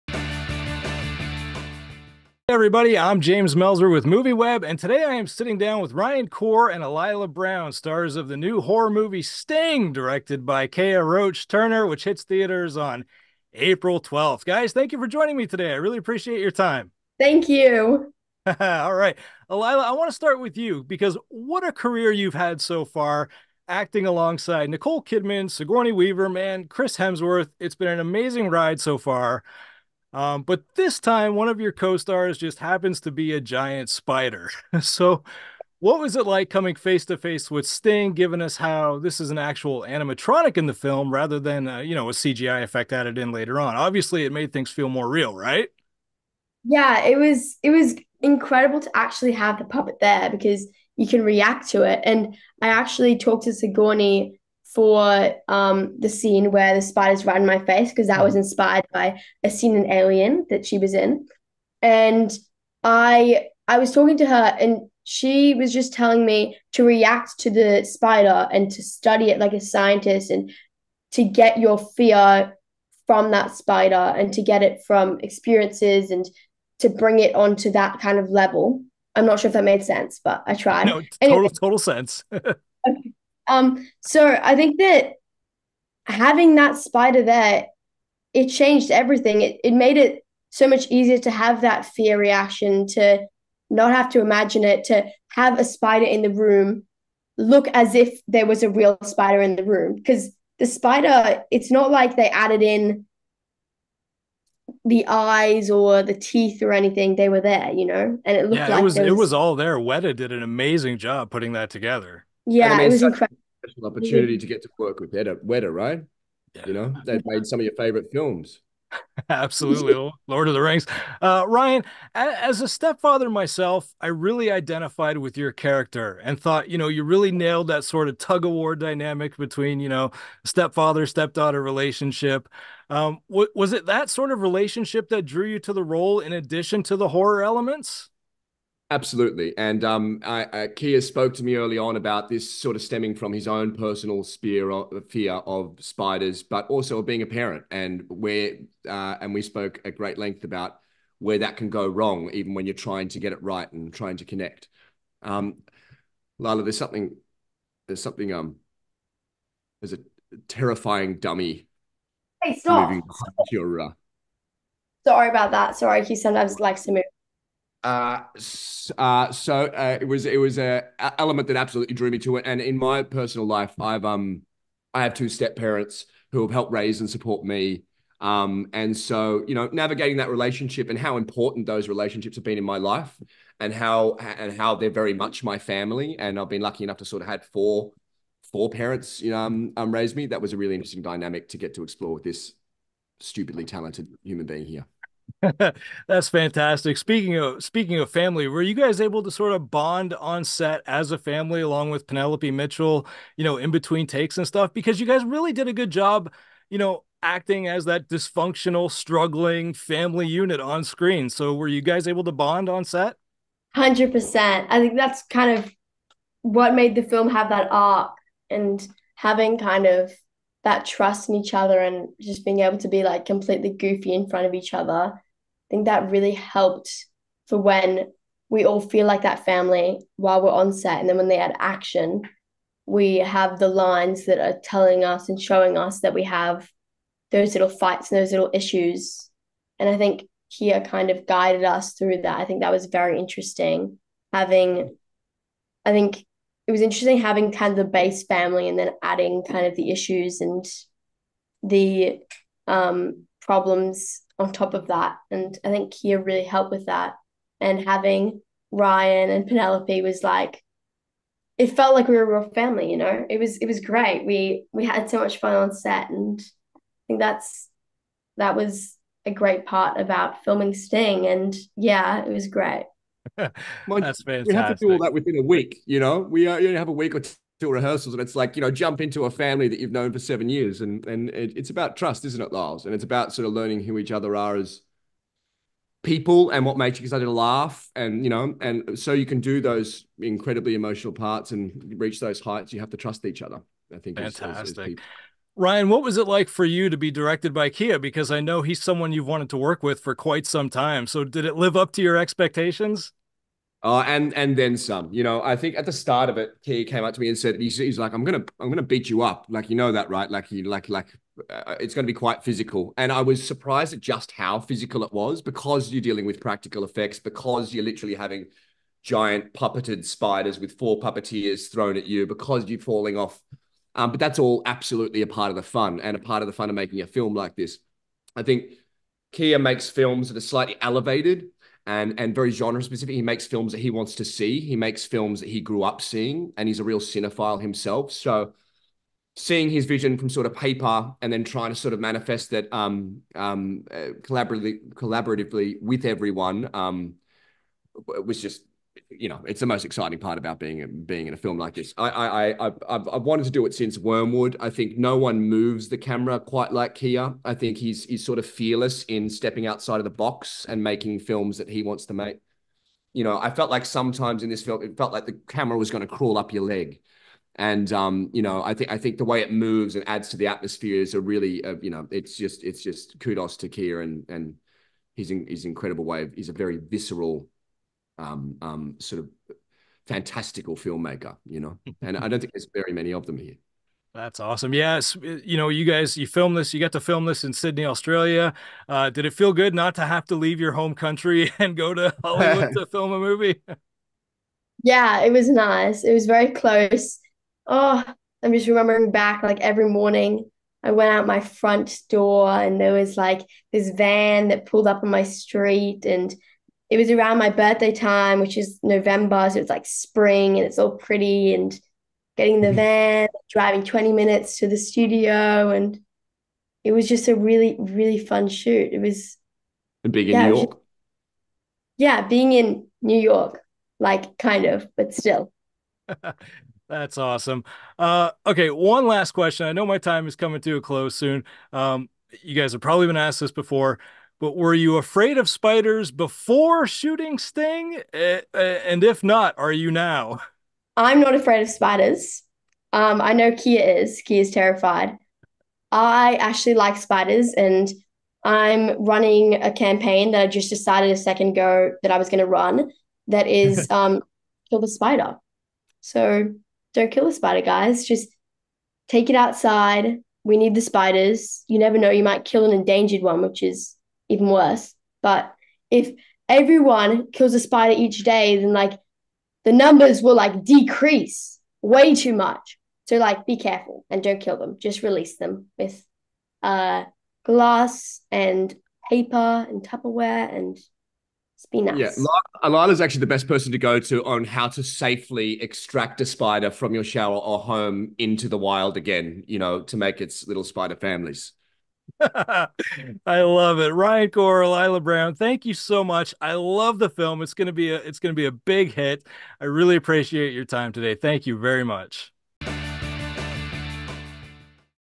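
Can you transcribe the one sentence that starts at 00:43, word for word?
Obviously, it made things feel more real, right?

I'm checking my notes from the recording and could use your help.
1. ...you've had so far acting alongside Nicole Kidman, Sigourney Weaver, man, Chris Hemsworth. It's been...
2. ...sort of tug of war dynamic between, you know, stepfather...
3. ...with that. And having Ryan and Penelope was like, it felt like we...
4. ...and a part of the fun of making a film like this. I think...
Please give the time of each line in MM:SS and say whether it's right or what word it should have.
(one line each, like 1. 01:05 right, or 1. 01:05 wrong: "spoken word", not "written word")
1. 00:22 right
2. 02:07 right
3. 04:16 right
4. 05:25 right.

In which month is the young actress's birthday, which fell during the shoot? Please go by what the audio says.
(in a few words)
November.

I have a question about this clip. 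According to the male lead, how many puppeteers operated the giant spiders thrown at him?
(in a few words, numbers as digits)
4.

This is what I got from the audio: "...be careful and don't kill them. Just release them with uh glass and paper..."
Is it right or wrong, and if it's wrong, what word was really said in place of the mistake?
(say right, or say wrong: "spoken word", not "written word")
right.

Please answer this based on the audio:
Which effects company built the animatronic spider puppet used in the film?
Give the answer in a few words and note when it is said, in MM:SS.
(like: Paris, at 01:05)
Weta, at 01:49.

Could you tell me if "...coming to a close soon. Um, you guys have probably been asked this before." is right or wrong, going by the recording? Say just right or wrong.
right.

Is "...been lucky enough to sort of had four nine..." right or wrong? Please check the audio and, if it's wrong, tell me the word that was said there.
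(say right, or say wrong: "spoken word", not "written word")
wrong: "four", not "nine".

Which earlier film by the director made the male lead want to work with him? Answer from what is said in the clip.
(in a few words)
Wormwood.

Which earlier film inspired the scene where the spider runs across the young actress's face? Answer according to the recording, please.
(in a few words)
Alien.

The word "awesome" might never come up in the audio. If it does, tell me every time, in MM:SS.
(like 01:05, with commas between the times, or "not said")
06:24, 07:07.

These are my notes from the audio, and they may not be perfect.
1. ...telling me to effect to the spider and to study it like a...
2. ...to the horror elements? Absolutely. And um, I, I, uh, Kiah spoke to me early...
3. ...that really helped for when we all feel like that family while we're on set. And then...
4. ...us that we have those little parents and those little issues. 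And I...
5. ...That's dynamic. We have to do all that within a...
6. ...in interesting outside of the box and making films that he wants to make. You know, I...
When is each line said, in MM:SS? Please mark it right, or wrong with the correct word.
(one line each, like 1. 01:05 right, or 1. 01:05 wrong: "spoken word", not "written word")
1. 01:05 wrong: "react", not "effect"
2. 02:16 right
3. 03:45 right
4. 03:55 wrong: "fights", not "parents"
5. 04:34 wrong: "fantastic", not "dynamic"
6. 05:59 wrong: "stepping", not "interesting".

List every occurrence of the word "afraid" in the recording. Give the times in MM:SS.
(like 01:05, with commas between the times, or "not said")
07:14, 07:21.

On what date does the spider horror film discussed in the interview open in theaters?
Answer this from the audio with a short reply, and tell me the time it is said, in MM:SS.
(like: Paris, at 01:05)
April 12th, at 00:13.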